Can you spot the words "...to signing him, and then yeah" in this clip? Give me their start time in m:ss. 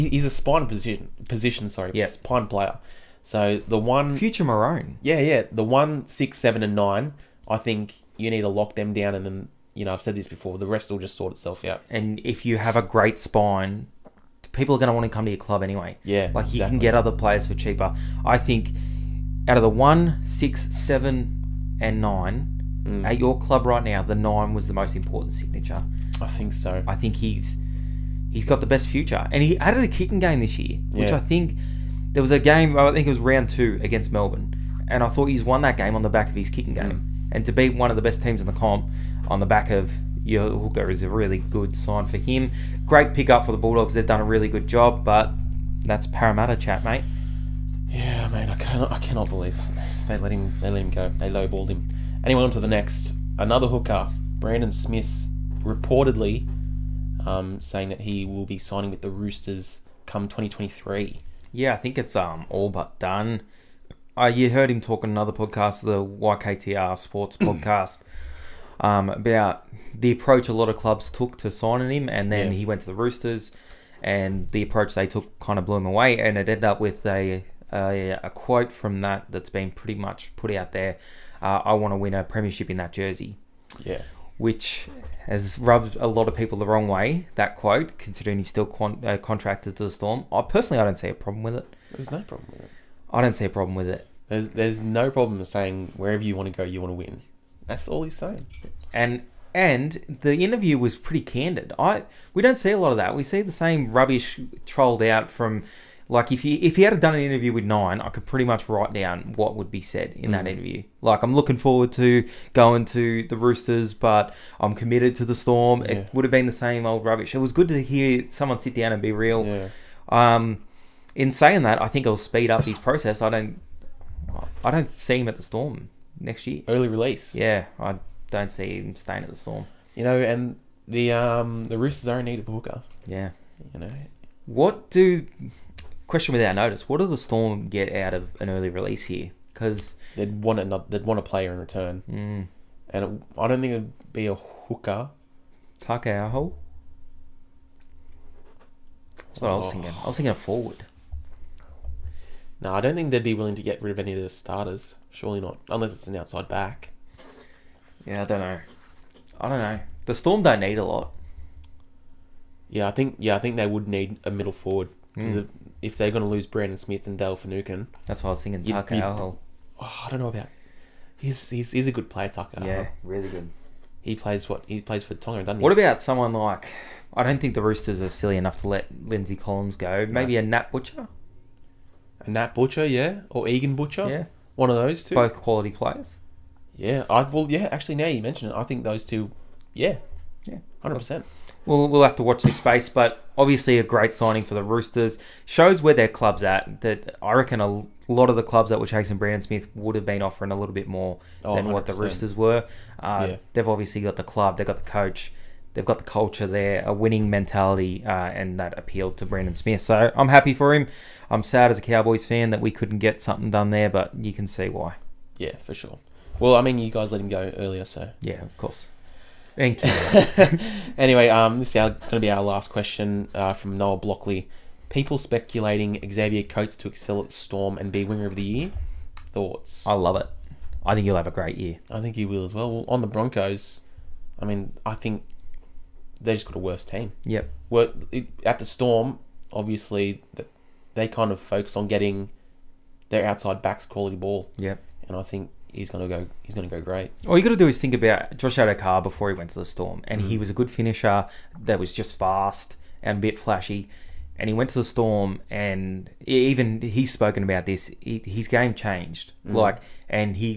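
1:11.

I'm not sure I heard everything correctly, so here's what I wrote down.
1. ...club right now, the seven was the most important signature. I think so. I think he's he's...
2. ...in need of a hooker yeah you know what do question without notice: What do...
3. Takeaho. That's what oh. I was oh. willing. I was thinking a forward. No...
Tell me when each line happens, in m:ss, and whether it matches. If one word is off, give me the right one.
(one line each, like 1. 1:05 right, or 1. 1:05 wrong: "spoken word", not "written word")
1. 0:23 wrong: "nine", not "seven"
2. 2:12 right
3. 2:25 wrong: "thinking", not "willing".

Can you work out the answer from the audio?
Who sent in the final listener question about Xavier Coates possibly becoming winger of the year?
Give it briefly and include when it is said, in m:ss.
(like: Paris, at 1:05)
Noah Blockley, at 3:43.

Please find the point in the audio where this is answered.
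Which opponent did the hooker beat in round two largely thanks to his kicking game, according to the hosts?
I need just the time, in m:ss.
0:34.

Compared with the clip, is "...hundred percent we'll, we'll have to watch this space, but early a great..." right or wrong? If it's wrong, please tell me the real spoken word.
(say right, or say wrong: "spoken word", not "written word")
wrong: "obviously", not "early".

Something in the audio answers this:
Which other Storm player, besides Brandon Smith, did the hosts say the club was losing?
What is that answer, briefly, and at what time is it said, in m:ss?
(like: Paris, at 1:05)
Dale Finucane, at 2:47.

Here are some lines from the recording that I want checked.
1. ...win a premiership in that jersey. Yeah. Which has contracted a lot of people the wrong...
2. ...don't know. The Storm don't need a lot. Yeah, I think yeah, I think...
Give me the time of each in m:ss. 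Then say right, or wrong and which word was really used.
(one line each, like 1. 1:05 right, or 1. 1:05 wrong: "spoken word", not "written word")
1. 1:21 wrong: "rubbed", not "contracted"
2. 2:39 right.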